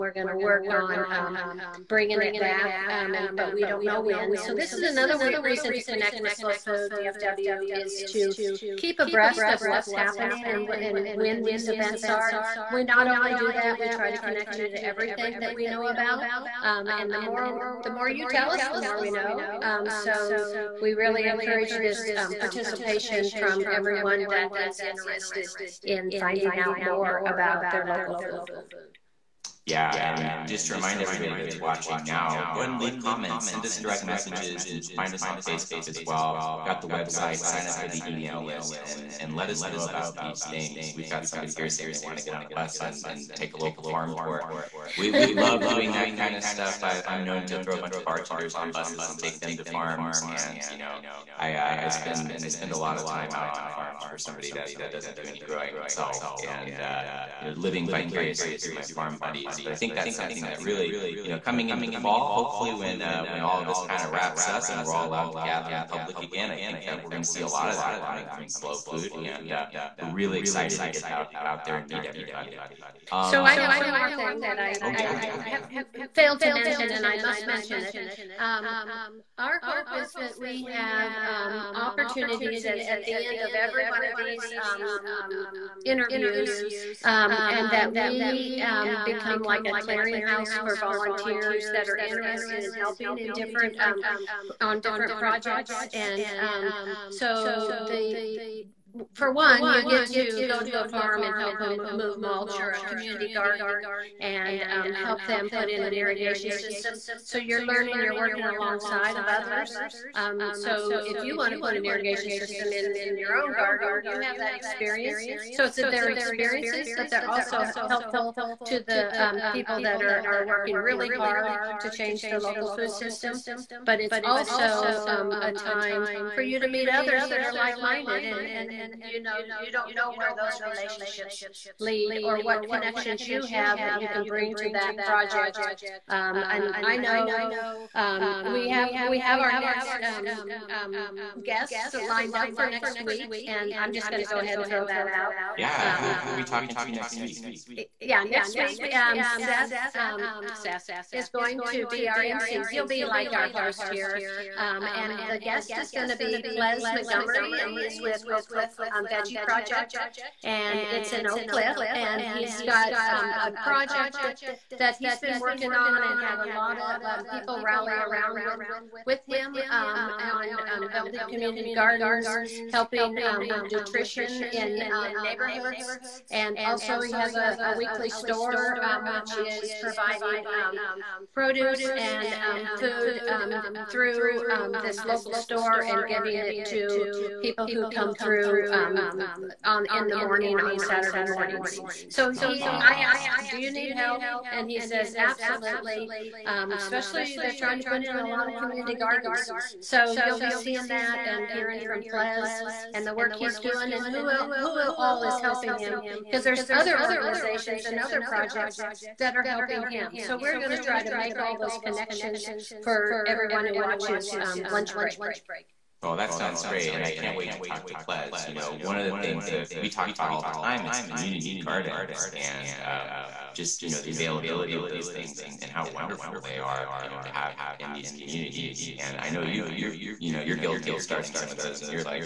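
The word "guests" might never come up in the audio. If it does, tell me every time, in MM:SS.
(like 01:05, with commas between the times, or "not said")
02:21, 02:35.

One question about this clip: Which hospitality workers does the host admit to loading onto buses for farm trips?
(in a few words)
Bartenders.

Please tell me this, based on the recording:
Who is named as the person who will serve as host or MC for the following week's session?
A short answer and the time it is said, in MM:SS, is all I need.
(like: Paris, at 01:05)
Seth, at 02:29.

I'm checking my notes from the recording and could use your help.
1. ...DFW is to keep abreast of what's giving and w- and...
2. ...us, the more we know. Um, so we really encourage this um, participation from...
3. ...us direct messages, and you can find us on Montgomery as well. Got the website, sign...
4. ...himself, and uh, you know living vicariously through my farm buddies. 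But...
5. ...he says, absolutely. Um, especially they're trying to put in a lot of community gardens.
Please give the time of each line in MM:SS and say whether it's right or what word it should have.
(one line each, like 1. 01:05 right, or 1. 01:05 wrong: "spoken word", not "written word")
1. 00:06 wrong: "happening", not "giving"
2. 00:18 right
3. 00:33 wrong: "Facebook", not "Montgomery"
4. 00:55 right
5. 03:14 right.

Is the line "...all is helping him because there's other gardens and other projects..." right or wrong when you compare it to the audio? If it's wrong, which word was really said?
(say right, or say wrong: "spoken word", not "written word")
wrong: "organizations", not "gardens".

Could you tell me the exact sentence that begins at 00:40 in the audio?
We've got somebody here saying they want to get on a bus and, and take a local farm tour.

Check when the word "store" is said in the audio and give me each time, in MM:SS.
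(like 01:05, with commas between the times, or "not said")
02:58, 03:05.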